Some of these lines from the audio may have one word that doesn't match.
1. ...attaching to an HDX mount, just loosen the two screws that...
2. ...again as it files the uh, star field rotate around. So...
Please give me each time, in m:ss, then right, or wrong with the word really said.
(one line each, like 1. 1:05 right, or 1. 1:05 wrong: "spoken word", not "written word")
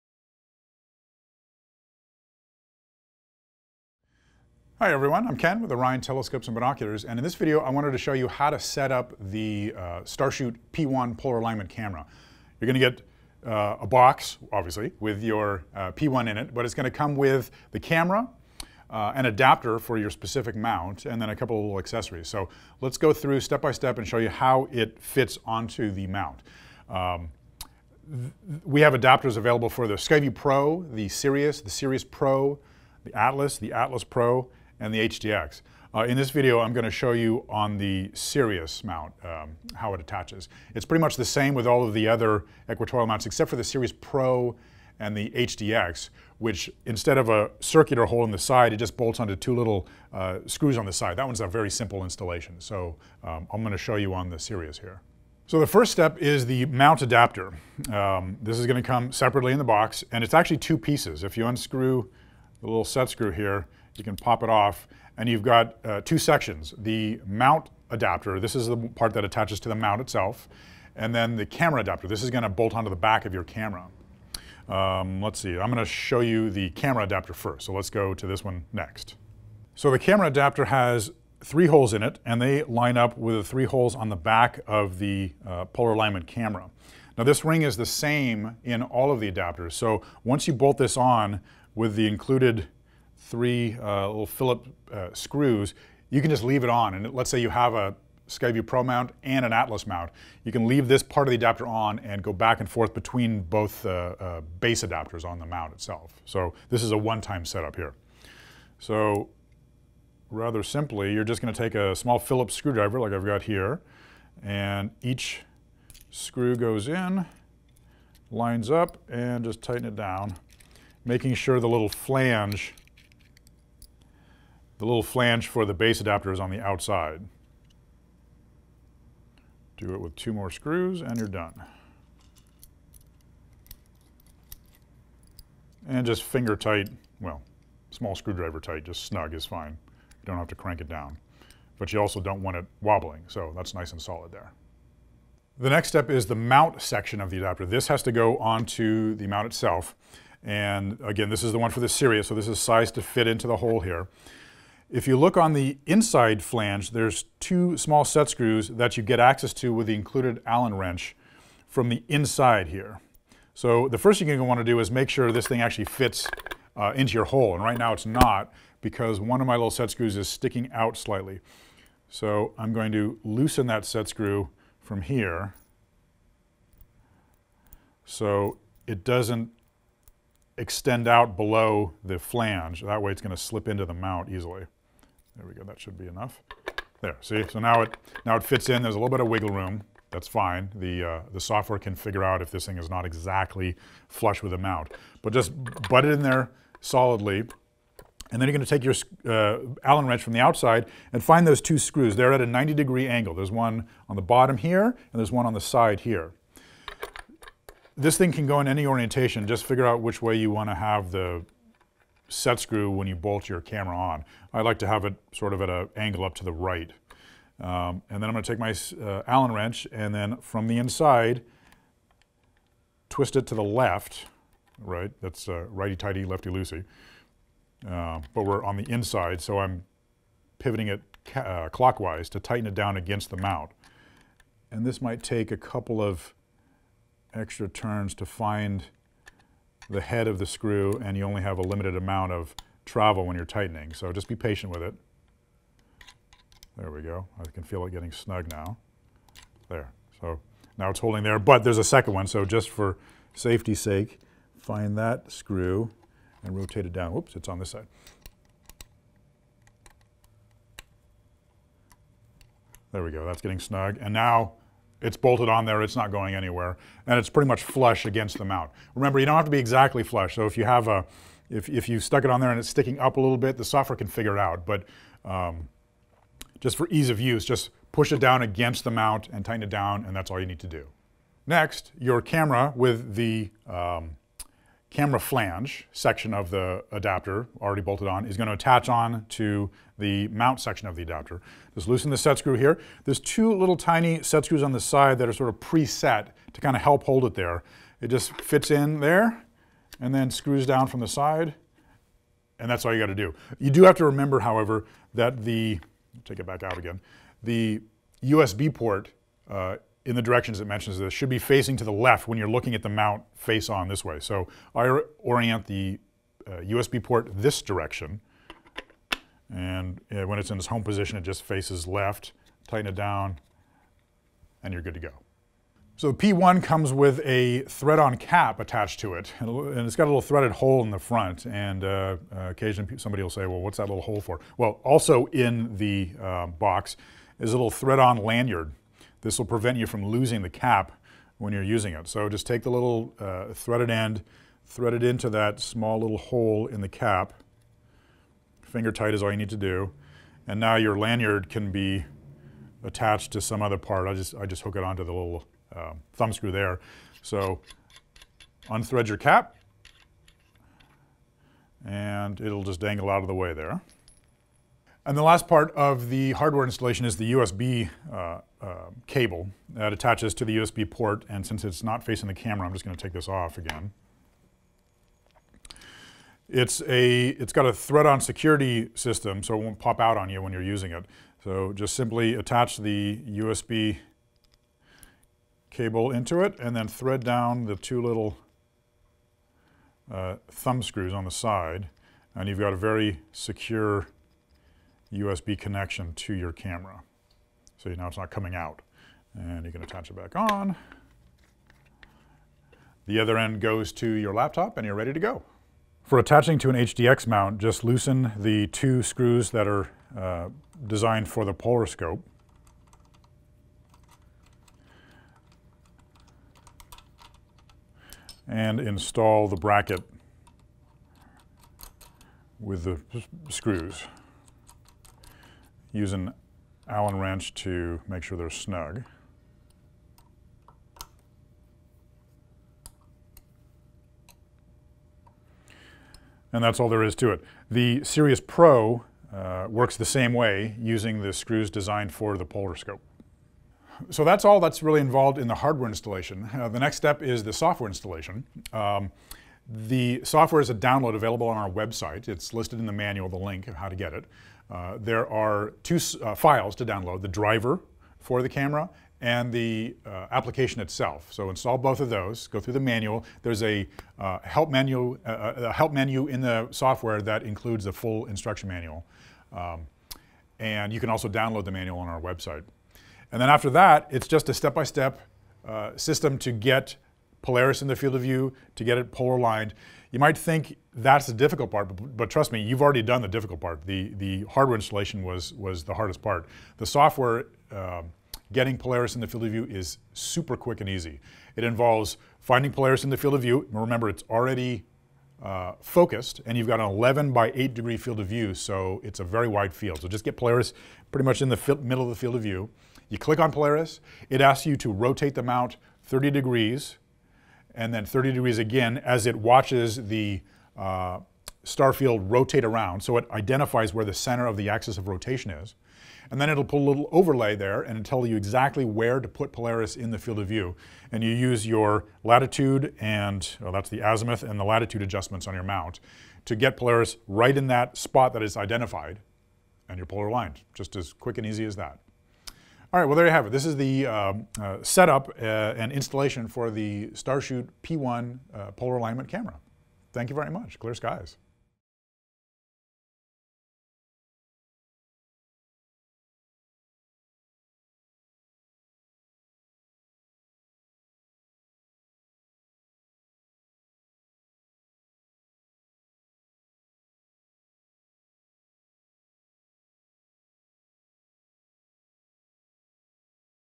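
1. 6:46 right
2. 8:28 wrong: "watches", not "files".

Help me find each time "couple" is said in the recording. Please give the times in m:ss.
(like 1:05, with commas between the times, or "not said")
0:21, 3:55.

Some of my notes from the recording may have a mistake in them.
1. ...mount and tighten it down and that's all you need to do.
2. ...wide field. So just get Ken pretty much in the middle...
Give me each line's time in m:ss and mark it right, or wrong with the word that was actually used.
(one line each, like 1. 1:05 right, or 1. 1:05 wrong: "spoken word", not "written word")
1. 4:38 right
2. 8:19 wrong: "Polaris", not "Ken".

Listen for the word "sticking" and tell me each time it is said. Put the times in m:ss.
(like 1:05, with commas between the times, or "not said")
2:50, 4:32.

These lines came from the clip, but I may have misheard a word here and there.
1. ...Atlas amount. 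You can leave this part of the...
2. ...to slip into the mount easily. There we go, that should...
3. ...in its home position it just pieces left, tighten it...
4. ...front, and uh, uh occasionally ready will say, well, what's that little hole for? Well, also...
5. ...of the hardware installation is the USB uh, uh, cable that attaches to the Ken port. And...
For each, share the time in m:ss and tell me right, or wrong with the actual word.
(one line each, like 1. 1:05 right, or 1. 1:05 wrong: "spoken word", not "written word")
1. 1:39 wrong: "mount", not "amount"
2. 3:03 right
3. 5:20 wrong: "faces", not "pieces"
4. 5:30 wrong: "somebody", not "ready"
5. 6:05 wrong: "USB", not "Ken".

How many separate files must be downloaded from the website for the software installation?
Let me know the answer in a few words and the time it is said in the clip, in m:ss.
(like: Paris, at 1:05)
2, at 7:35.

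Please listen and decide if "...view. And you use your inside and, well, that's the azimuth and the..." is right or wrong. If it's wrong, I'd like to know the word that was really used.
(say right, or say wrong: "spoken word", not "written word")
wrong: "latitude", not "inside".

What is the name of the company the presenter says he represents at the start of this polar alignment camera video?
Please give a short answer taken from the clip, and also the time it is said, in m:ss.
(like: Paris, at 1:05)
Orion Telescopes and Binoculars, at 0:05.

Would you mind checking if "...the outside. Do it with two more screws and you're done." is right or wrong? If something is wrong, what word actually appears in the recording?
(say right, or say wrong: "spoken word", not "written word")
right.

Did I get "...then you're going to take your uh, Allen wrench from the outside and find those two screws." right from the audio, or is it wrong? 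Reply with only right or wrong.
right.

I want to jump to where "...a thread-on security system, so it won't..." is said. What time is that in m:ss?
6:17.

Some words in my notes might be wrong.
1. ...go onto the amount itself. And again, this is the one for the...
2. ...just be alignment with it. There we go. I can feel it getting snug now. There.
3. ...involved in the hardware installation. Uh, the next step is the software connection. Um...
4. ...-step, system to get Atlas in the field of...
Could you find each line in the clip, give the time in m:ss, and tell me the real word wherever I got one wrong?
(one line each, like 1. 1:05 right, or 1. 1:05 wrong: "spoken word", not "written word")
1. 2:28 wrong: "mount", not "amount"
2. 4:04 wrong: "patient", not "alignment"
3. 7:24 wrong: "installation", not "connection"
4. 7:55 wrong: "Polaris", not "Atlas".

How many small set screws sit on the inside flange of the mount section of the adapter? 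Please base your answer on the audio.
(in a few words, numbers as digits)
2.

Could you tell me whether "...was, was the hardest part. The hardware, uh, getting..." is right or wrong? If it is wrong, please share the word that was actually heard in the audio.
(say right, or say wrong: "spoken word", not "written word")
wrong: "software", not "hardware".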